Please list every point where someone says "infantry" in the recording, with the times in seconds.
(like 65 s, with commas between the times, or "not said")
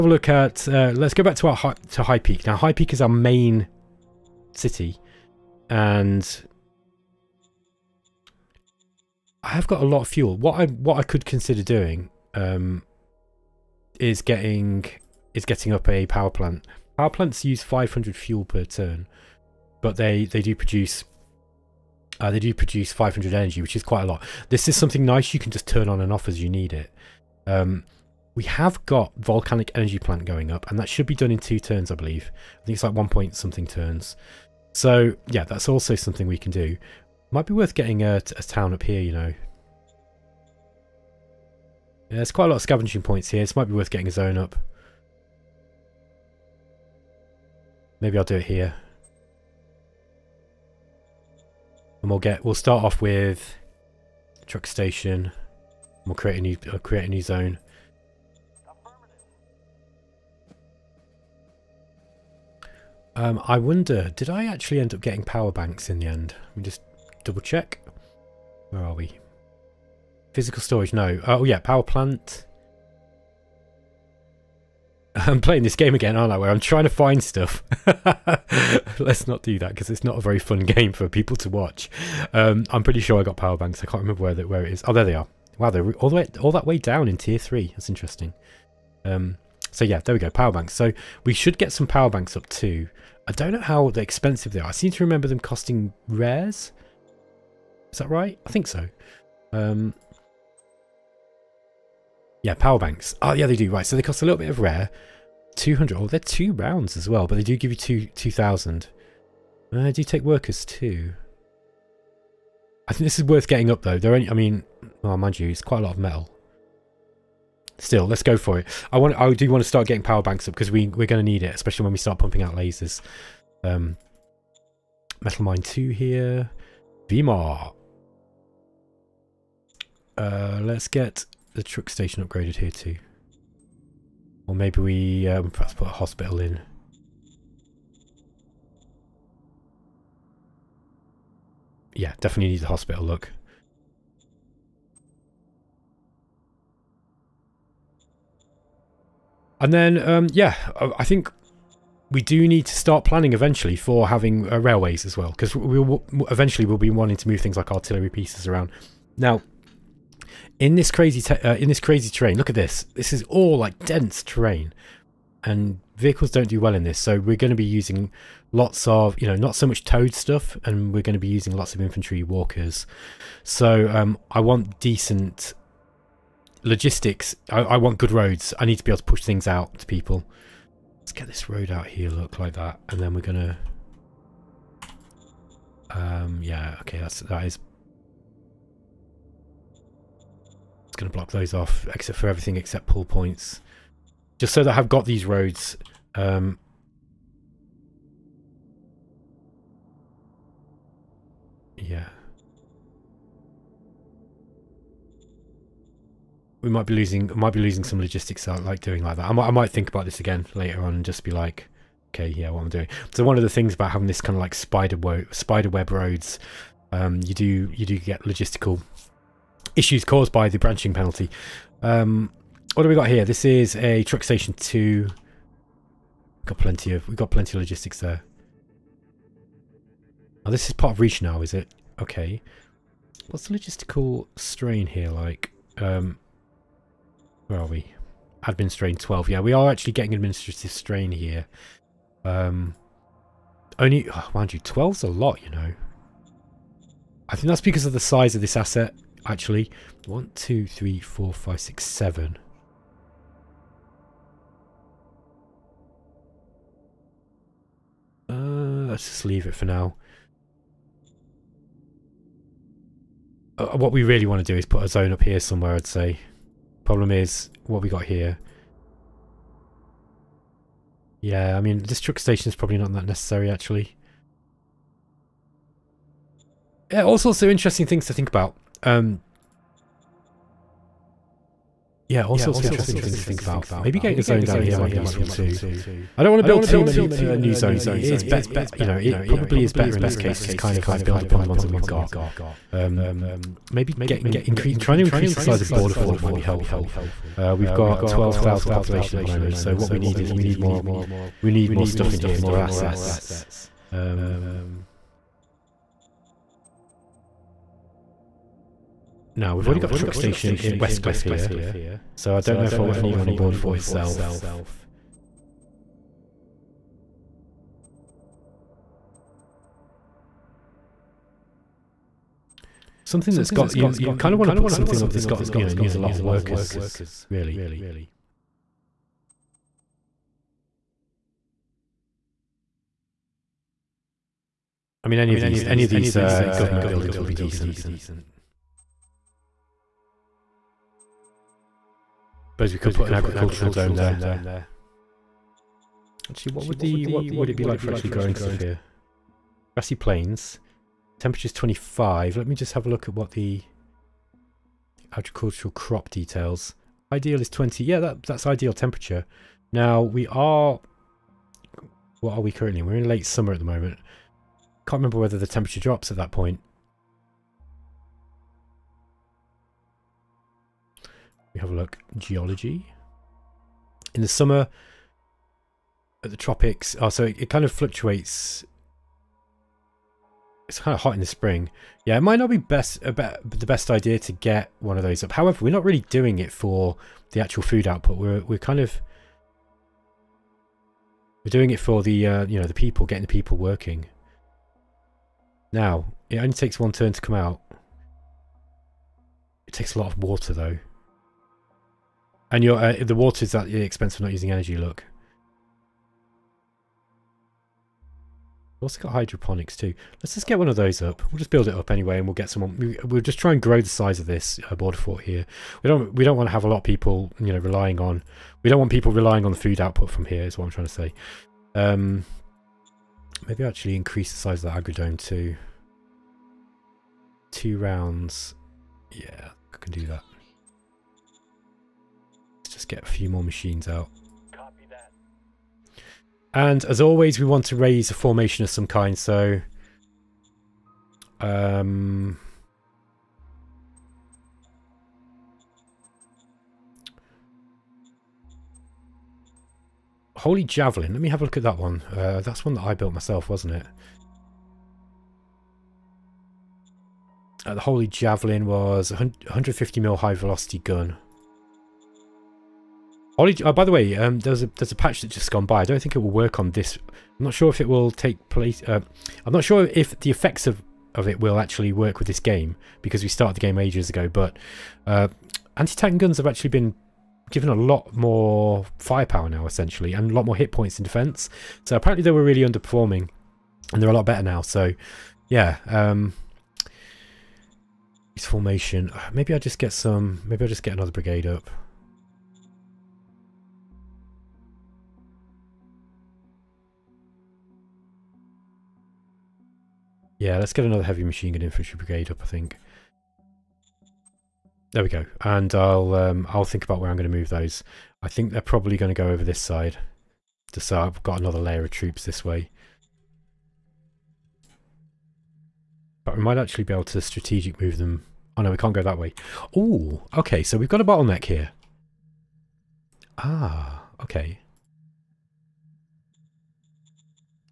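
171 s, 501 s.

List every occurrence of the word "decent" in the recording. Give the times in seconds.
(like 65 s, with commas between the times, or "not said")
174 s, 337 s.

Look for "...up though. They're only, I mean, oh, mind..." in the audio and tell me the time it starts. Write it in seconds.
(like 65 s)
113 s.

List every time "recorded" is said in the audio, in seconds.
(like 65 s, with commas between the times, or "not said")
not said.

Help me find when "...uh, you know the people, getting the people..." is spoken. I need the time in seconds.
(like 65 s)
392 s.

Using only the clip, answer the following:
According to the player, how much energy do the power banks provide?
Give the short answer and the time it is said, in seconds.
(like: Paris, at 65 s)
2,000, at 108 s.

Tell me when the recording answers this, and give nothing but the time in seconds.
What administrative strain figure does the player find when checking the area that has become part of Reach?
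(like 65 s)
238 s.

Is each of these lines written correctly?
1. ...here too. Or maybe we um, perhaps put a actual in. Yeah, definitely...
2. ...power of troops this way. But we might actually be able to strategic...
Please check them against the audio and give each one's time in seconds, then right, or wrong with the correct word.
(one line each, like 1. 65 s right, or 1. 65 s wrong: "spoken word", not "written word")
1. 132 s wrong: "hospital", not "actual"
2. 511 s wrong: "layer", not "power".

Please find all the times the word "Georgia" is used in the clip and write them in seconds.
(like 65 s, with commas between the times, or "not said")
not said.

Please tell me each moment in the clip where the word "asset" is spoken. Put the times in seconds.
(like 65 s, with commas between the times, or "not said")
248 s, 302 s.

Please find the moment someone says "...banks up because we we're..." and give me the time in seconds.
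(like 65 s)
120 s.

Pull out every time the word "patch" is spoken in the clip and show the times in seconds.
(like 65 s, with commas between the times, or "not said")
464 s.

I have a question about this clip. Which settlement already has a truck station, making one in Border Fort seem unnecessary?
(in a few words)
Westcliff.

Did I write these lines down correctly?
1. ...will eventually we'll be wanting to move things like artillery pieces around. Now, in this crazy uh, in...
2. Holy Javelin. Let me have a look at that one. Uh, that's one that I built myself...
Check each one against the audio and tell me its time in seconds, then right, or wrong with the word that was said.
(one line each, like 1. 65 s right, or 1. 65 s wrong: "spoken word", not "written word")
1. 155 s right
2. 450 s right.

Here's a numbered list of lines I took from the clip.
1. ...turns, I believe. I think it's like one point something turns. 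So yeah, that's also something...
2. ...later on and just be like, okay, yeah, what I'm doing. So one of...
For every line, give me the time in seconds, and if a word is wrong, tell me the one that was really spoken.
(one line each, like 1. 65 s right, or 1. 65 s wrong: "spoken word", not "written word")
1. 31 s right
2. 210 s right.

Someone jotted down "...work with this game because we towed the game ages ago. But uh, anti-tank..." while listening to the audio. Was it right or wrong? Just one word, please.
wrong.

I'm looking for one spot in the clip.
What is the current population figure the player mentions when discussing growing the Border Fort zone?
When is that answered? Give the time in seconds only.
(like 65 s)
298 s.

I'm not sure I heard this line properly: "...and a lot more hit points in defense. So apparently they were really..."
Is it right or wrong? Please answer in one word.
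right.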